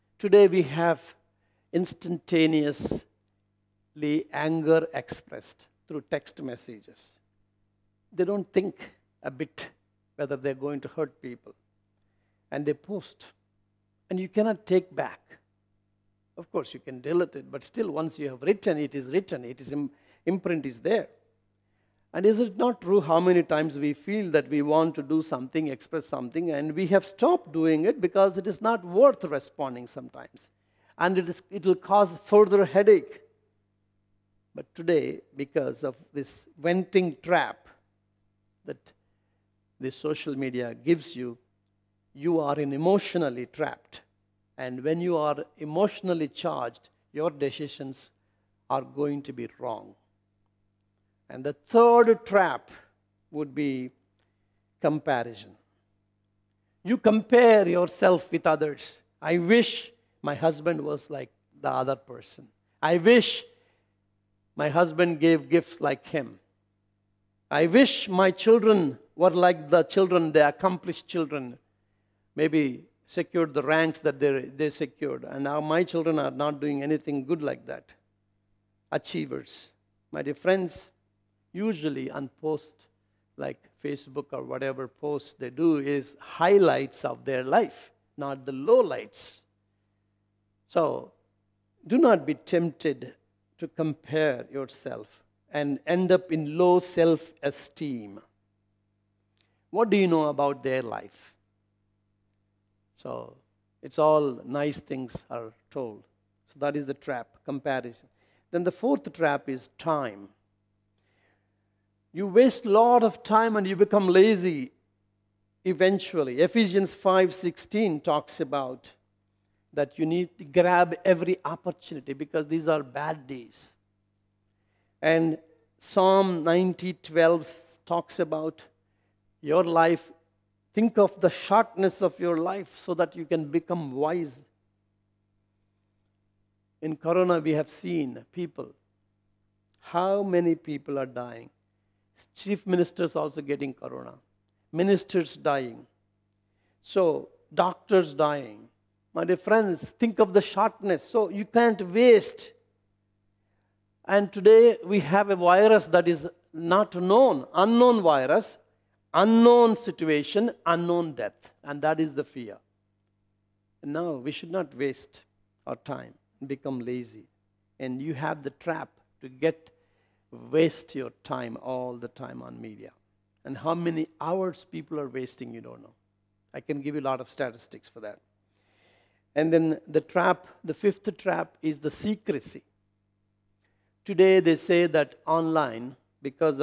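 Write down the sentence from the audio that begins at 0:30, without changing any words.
And it, is, it will cause further headache.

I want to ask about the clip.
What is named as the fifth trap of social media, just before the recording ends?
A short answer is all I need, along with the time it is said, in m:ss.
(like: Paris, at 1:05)
Secrecy, at 3:01.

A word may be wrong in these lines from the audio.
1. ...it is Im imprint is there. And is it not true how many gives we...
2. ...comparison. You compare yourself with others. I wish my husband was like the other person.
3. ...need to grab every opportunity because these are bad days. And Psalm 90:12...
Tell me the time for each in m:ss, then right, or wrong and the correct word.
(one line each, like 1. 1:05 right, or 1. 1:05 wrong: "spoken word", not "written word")
1. 0:19 wrong: "times", not "gives"
2. 0:54 right
3. 2:00 right.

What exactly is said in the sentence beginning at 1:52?
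You waste a lot of time and you become lazy eventually.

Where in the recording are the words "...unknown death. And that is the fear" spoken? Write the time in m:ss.
2:40.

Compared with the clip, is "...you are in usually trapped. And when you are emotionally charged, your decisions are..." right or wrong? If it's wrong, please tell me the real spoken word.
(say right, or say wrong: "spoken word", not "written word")
wrong: "emotionally", not "usually".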